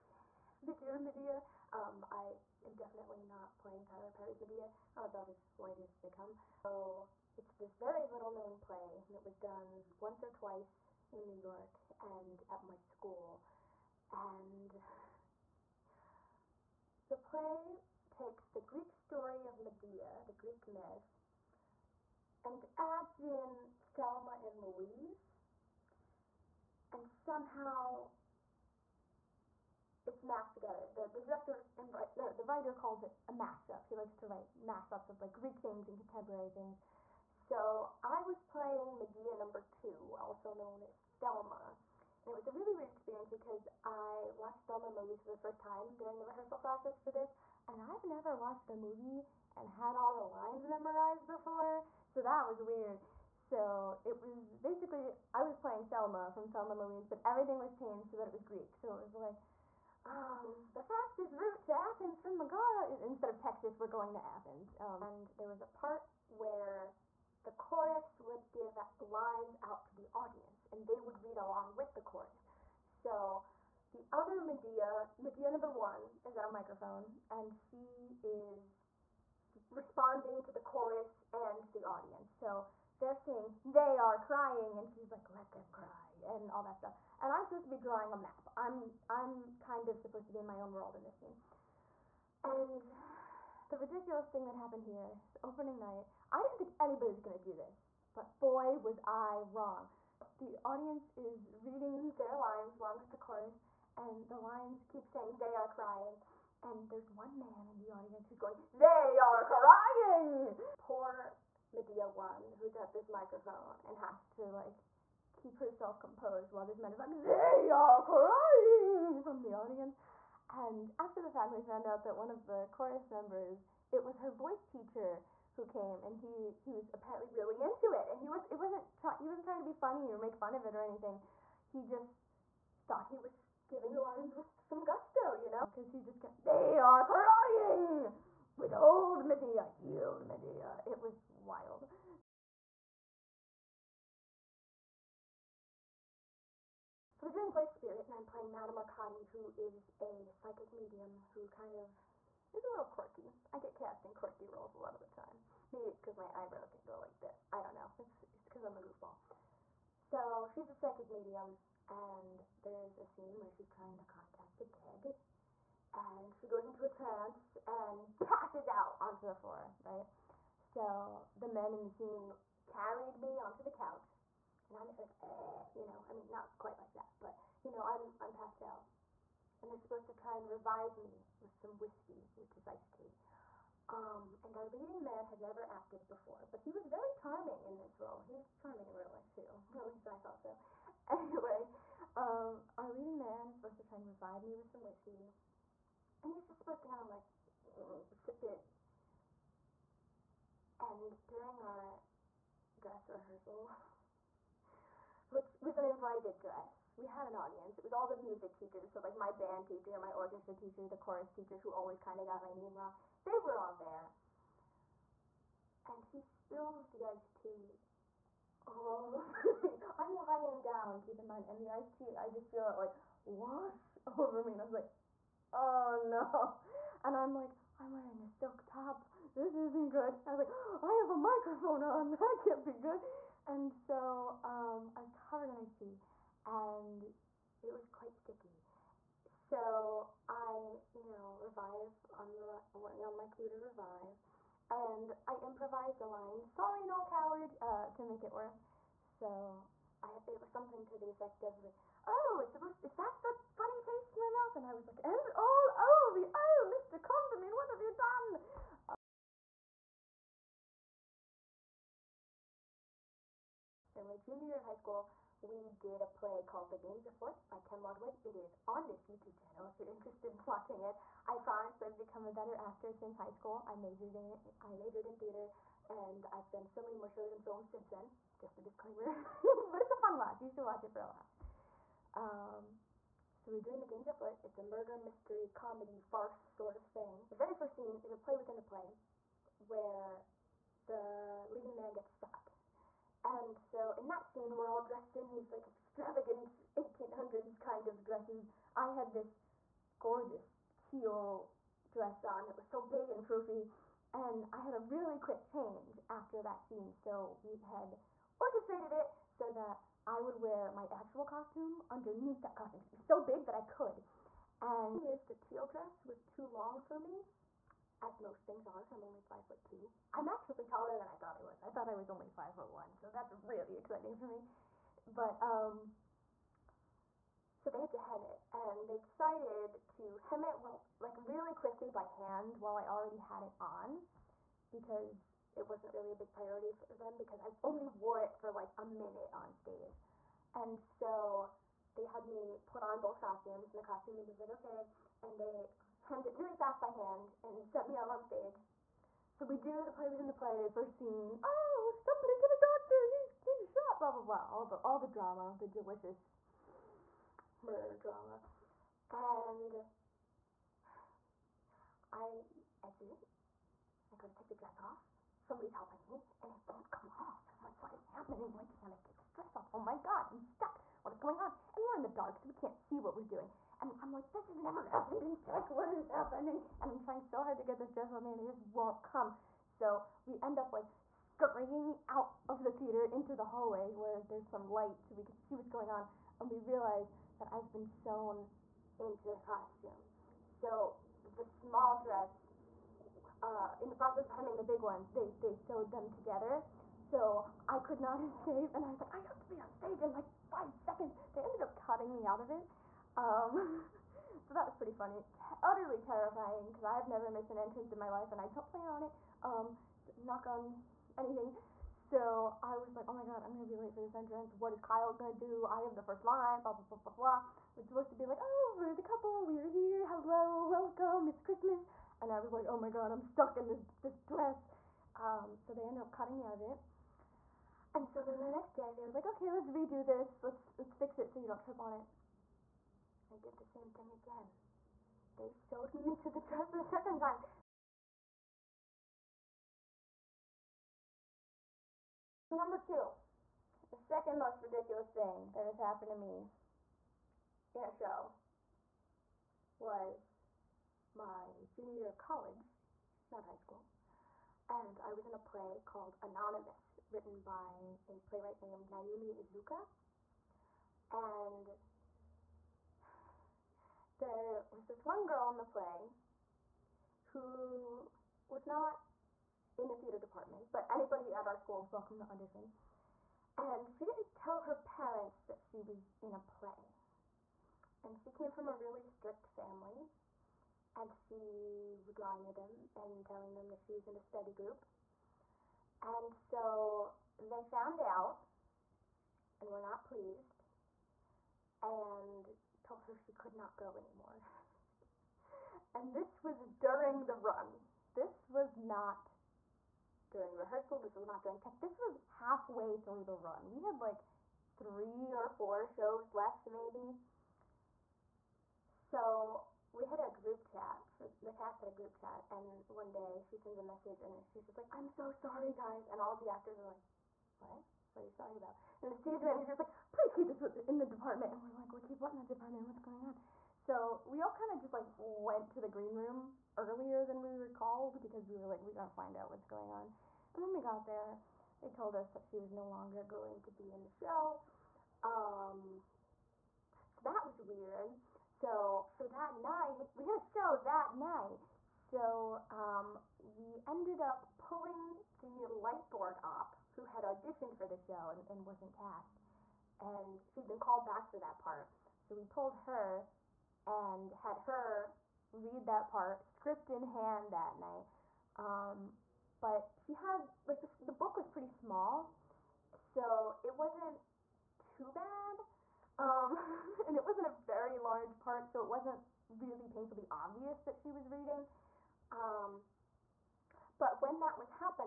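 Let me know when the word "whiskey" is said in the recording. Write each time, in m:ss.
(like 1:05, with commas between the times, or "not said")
3:01, 3:14.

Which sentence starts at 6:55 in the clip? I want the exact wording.
I have the first line, blah, blah, blah, blah, blah.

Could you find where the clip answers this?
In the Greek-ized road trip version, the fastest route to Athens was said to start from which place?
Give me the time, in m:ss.
1:02.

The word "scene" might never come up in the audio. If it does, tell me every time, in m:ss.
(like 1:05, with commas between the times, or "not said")
1:31, 2:43, 2:51, 4:47, 4:54, 5:06, 5:50.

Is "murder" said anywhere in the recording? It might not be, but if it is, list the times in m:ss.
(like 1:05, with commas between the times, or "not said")
4:44, 5:57.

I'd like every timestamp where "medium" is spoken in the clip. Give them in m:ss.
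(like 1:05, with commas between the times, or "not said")
2:30, 2:41.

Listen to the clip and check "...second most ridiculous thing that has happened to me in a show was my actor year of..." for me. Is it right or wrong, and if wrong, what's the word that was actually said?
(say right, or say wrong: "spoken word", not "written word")
wrong: "junior", not "actor".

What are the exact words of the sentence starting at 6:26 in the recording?
And we realize that I've been sewn into the costume.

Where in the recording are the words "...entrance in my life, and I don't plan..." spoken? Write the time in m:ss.
6:47.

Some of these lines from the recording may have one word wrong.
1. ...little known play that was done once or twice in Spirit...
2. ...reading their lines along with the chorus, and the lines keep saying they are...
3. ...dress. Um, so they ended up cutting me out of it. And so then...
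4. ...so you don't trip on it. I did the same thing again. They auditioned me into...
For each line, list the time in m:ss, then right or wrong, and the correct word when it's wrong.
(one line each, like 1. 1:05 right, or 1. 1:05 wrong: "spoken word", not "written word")
1. 0:08 wrong: "New", not "Spirit"
2. 1:41 right
3. 7:04 right
4. 7:11 wrong: "sewed", not "auditioned".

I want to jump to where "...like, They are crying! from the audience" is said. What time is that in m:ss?
1:56.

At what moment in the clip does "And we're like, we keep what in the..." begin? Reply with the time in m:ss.
8:41.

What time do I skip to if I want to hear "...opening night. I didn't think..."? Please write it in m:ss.
1:35.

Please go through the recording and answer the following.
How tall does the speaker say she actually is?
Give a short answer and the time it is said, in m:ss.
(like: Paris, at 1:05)
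5 foot 2, at 5:19.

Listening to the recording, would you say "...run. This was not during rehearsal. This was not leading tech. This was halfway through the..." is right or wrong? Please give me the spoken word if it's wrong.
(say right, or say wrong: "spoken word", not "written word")
wrong: "during", not "leading".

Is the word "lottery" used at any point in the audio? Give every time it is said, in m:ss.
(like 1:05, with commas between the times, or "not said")
not said.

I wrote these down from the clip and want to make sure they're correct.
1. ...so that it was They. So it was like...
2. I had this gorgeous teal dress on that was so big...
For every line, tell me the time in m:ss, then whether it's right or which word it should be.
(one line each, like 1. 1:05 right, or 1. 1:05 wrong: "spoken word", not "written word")
1. 0:58 wrong: "Greek", not "They"
2. 4:58 right.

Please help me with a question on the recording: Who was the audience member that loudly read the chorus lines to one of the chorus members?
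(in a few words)
Her voice teacher.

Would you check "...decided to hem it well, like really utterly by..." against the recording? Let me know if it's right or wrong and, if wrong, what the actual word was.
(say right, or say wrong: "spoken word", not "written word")
wrong: "quickly", not "utterly".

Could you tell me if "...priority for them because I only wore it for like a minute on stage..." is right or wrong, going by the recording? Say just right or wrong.
right.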